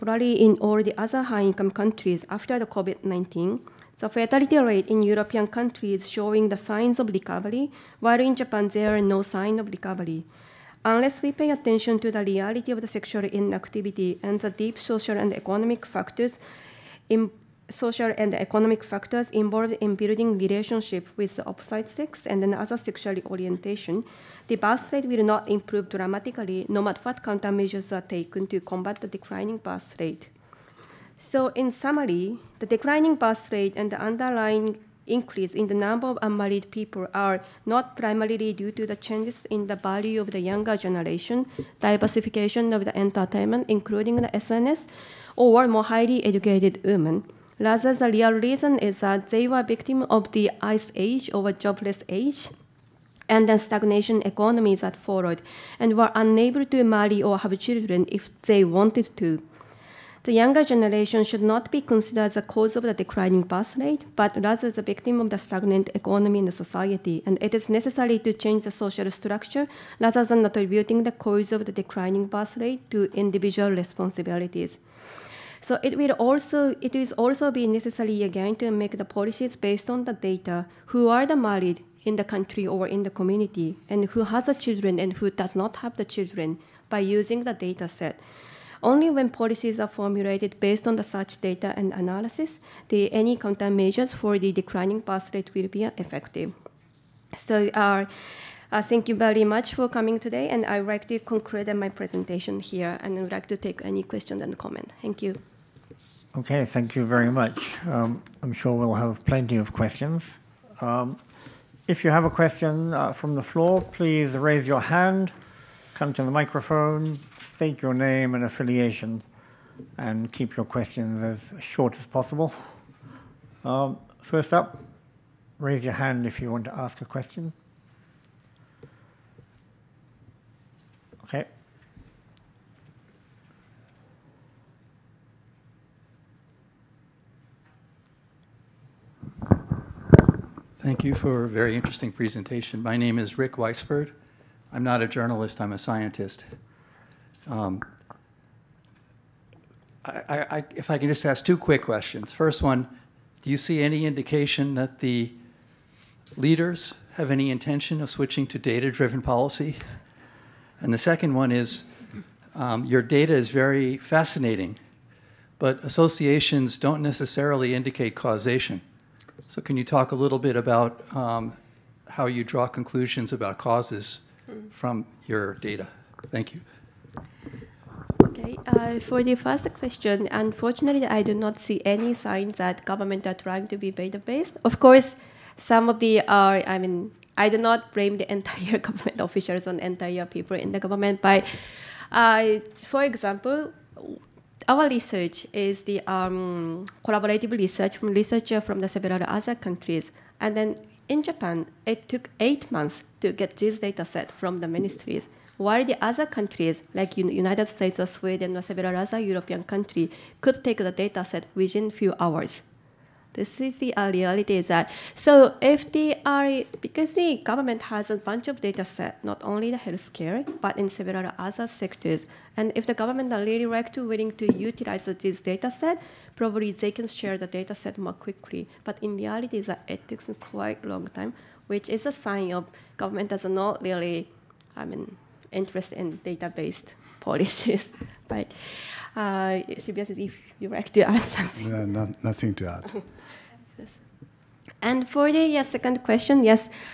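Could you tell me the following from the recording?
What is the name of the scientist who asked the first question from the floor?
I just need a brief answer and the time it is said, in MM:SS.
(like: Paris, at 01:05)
Rick Weisberg, at 02:23.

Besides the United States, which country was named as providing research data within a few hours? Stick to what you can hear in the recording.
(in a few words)
Sweden.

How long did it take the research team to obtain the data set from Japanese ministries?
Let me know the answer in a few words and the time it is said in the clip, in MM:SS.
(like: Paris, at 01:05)
8 months, at 03:22.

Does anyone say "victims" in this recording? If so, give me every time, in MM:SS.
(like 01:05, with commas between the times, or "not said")
00:49, 01:04.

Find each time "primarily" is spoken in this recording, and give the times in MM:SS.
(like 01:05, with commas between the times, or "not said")
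00:37.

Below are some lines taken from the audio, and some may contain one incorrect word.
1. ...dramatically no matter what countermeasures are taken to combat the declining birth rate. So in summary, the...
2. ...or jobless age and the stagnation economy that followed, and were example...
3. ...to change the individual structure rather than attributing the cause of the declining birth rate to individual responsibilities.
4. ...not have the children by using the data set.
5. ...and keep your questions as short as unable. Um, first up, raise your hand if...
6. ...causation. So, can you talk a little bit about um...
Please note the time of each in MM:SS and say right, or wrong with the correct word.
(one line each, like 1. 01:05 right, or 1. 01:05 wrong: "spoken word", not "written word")
1. 00:25 right
2. 00:51 wrong: "unable", not "example"
3. 01:08 wrong: "social", not "individual"
4. 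01:25 right
5. 01:59 wrong: "possible", not "unable"
6. 02:48 right.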